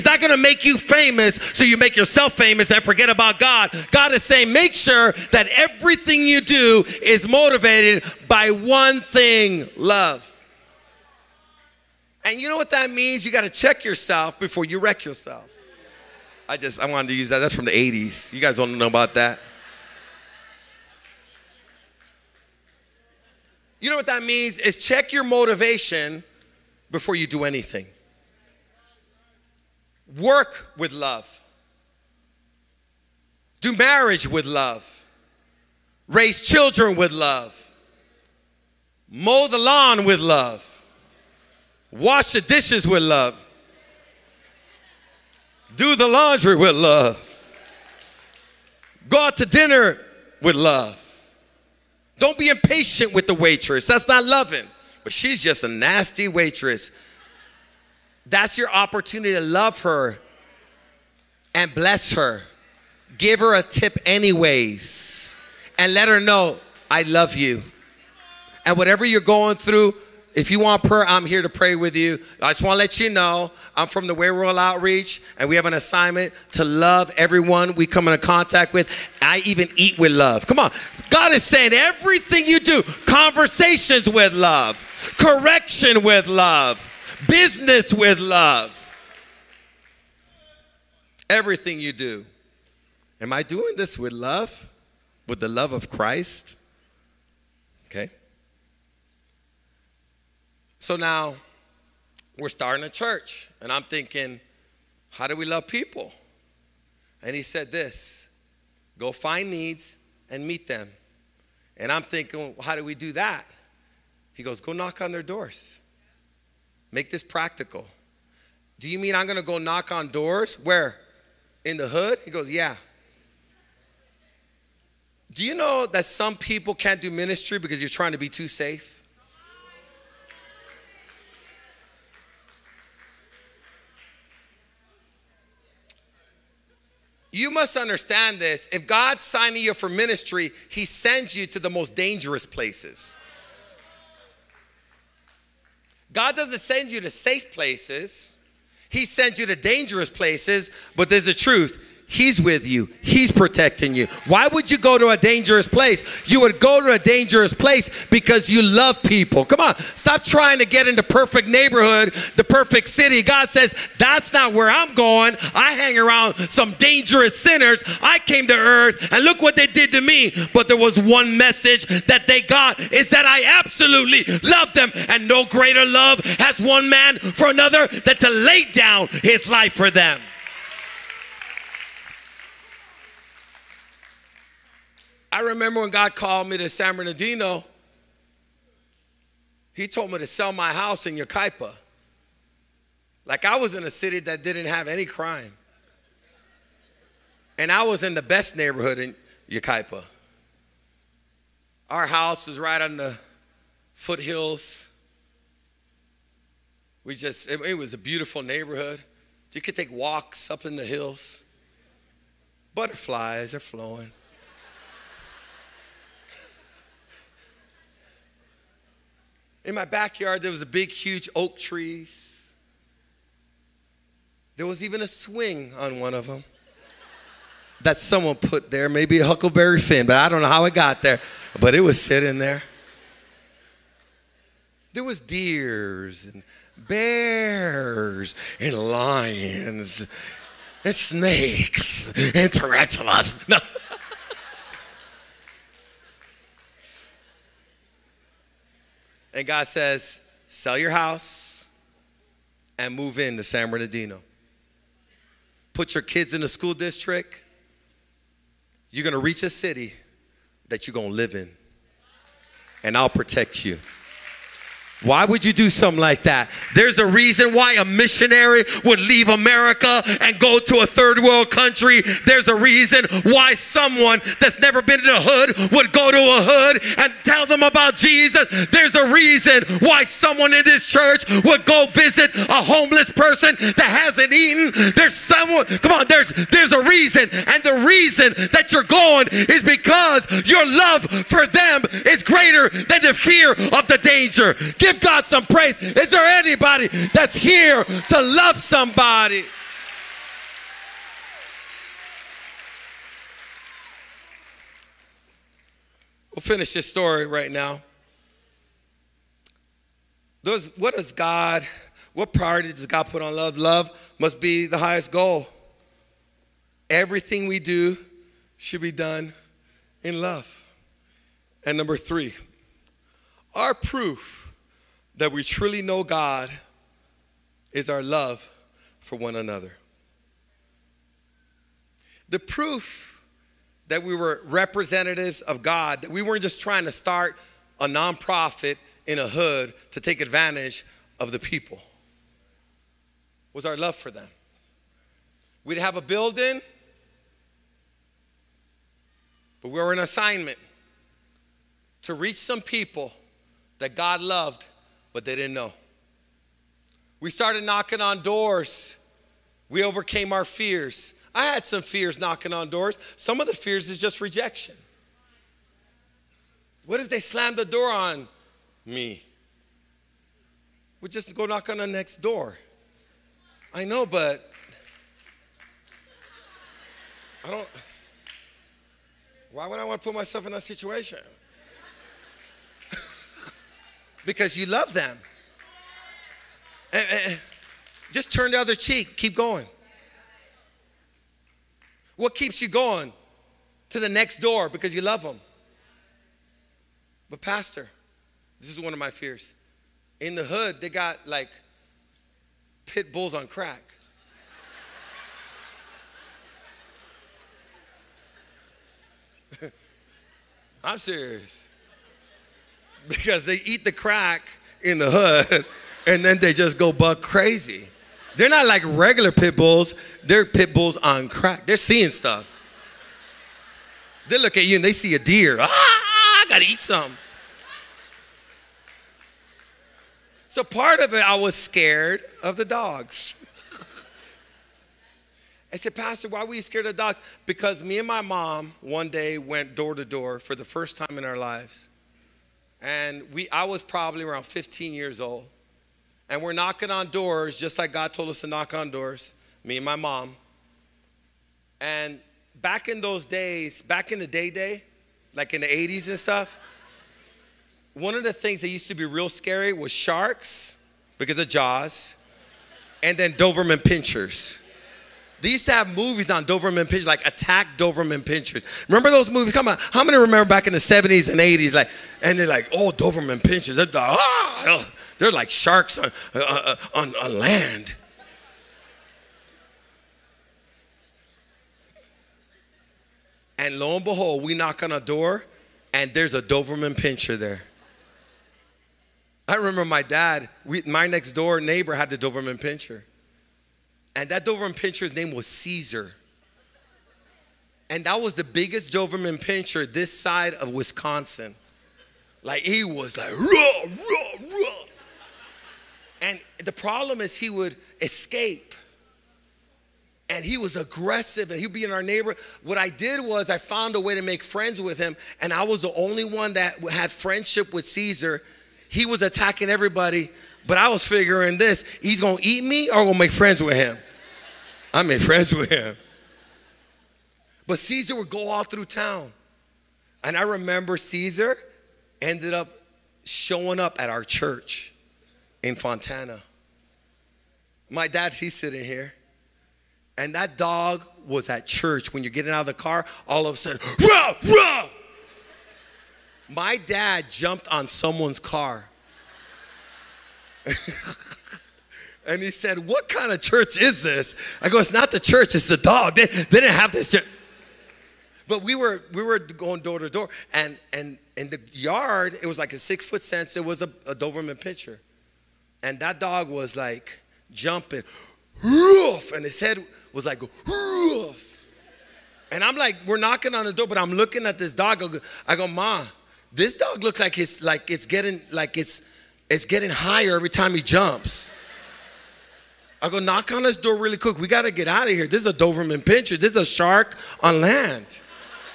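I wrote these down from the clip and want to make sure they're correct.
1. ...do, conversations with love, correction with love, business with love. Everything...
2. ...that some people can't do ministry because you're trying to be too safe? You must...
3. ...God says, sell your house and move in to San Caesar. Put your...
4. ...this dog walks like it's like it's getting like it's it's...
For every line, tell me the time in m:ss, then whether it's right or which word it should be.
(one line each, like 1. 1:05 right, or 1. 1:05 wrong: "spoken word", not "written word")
1. 1:22 right
2. 2:05 right
3. 4:09 wrong: "Bernardino", not "Caesar"
4. 9:36 wrong: "looks", not "walks".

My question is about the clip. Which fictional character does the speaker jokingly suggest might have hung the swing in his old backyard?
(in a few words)
Huckleberry Finn.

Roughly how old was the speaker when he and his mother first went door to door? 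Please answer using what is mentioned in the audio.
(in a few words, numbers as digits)
15.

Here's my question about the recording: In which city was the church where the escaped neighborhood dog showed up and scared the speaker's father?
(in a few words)
Fontana.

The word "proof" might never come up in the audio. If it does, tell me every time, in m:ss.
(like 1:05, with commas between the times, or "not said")
5:23, 5:32.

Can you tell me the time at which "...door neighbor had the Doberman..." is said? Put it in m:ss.
8:11.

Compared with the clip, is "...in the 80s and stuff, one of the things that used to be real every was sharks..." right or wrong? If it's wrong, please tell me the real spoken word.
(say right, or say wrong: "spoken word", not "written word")
wrong: "scary", not "every".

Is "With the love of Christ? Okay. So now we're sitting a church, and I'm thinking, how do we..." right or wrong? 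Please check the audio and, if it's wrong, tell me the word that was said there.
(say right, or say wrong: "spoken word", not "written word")
wrong: "starting", not "sitting".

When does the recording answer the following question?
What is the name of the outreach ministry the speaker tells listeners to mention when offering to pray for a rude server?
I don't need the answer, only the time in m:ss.
1:14.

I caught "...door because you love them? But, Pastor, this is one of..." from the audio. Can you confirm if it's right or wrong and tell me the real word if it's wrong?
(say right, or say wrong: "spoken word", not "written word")
right.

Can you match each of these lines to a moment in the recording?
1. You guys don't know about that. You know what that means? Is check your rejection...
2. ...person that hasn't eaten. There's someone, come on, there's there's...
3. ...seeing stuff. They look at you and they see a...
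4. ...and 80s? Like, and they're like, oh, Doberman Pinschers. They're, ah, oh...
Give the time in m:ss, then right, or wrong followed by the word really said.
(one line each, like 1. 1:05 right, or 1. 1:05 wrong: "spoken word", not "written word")
1. 0:18 wrong: "motivation", not "rejection"
2. 4:43 right
3. 7:01 right
4. 7:51 right.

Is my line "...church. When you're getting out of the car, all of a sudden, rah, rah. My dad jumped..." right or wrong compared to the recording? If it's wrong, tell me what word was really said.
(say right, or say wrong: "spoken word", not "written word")
right.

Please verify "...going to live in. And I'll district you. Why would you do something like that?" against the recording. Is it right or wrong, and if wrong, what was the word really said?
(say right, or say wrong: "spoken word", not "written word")
wrong: "protect", not "district".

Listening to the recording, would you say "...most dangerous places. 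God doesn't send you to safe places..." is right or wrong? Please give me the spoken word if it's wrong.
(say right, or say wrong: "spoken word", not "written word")
right.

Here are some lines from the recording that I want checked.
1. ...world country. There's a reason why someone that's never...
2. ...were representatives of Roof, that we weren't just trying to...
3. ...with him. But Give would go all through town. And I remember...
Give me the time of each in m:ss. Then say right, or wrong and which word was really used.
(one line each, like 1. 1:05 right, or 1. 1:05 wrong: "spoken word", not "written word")
1. 4:31 right
2. 5:34 wrong: "God", not "Roof"
3. 8:45 wrong: "Caesar", not "Give".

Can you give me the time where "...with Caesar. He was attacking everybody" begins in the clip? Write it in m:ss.
8:37.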